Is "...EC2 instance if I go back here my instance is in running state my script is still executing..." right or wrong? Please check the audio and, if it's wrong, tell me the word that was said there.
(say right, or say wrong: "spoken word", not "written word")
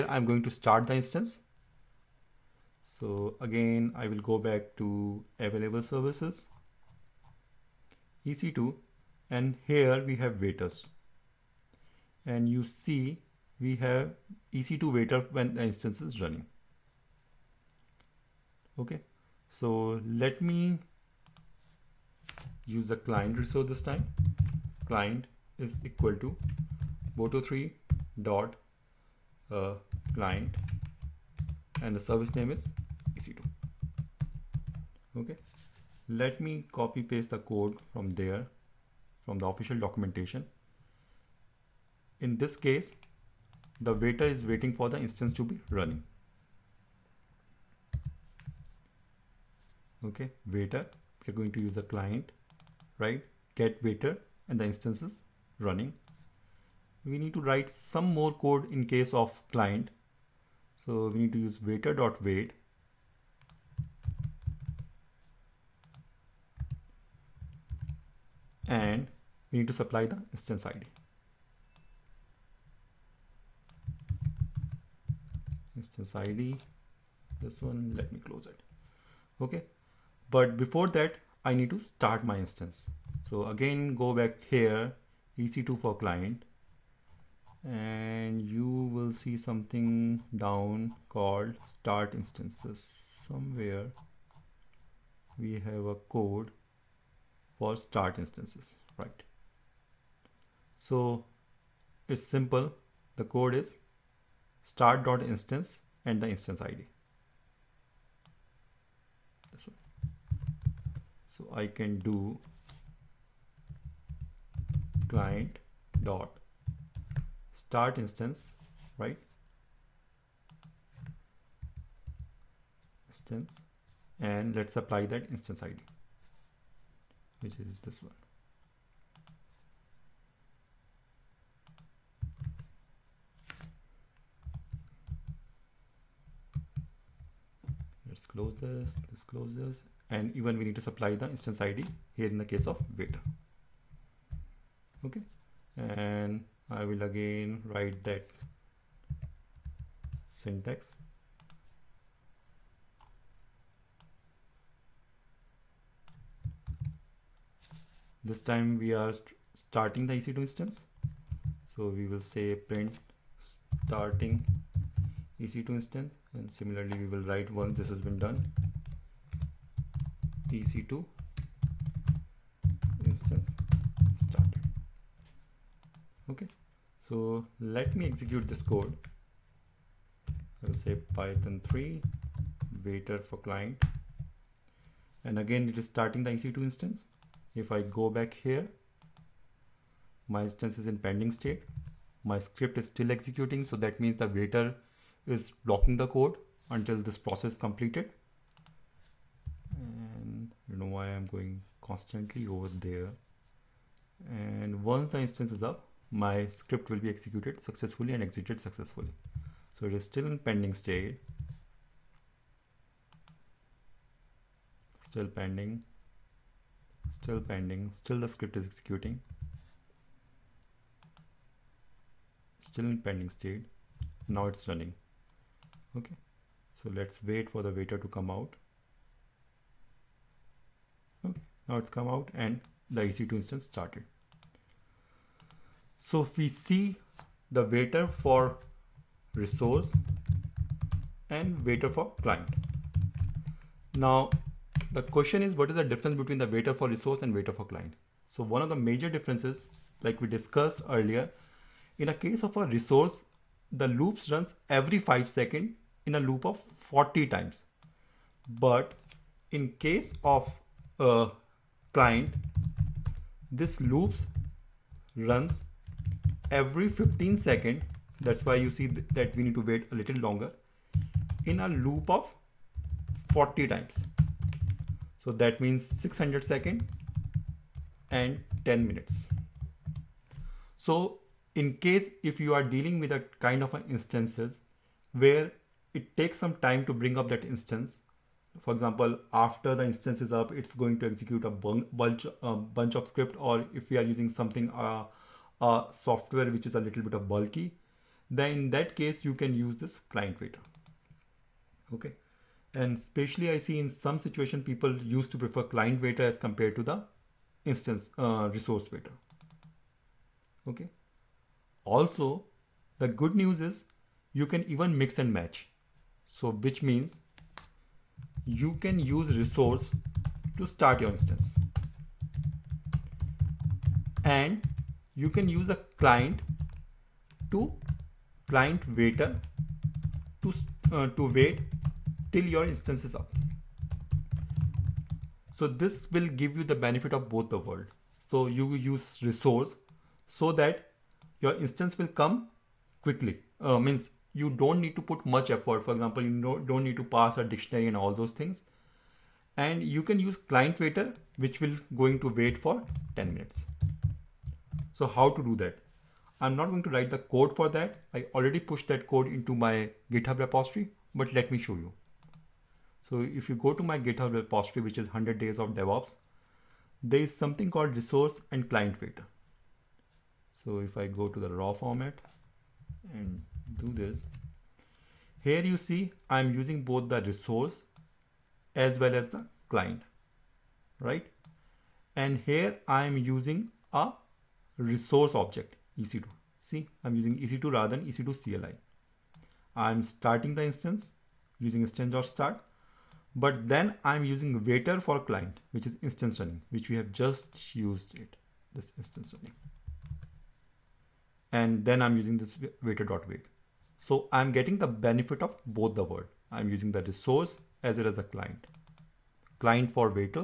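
wrong: "pending", not "running".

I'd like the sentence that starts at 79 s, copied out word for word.
Okay, but before that, I need to start my instance.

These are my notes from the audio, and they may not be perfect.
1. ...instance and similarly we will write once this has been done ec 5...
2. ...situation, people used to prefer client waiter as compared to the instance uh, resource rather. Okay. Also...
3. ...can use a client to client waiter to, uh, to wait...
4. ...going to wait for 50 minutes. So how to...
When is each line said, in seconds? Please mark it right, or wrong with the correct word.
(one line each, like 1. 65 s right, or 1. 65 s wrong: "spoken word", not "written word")
1. 165 s wrong: "2", not "5"
2. 304 s wrong: "waiter", not "rather"
3. 325 s right
4. 352 s wrong: "10", not "50".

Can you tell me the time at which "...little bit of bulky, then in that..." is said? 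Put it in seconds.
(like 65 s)
296 s.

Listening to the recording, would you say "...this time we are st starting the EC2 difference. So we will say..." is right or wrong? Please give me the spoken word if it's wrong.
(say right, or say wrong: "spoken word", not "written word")
wrong: "instance", not "difference".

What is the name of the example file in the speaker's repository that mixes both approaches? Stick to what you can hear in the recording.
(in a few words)
resource and client waiter.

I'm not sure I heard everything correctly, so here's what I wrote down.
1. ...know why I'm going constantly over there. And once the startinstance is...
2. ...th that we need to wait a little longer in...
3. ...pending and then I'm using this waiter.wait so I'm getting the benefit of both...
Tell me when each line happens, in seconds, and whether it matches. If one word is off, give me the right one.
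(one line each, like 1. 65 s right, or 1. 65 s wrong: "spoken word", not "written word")
1. 200 s wrong: "instance", not "startinstance"
2. 268 s right
3. 399 s wrong: "running", not "pending".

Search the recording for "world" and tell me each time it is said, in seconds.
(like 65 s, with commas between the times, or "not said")
337 s.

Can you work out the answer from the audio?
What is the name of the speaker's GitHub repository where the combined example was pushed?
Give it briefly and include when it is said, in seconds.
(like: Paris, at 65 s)
100 days of DevOps, at 365 s.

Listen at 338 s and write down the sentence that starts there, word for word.
So you use resource so that your instance will come quickly, uh, means you don't need to put much effort.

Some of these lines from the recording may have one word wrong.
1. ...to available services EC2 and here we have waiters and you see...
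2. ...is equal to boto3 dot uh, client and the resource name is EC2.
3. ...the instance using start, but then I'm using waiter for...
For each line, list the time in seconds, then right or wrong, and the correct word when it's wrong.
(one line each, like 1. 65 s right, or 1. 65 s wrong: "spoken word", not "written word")
1. 4 s right
2. 25 s wrong: "service", not "resource"
3. 390 s right.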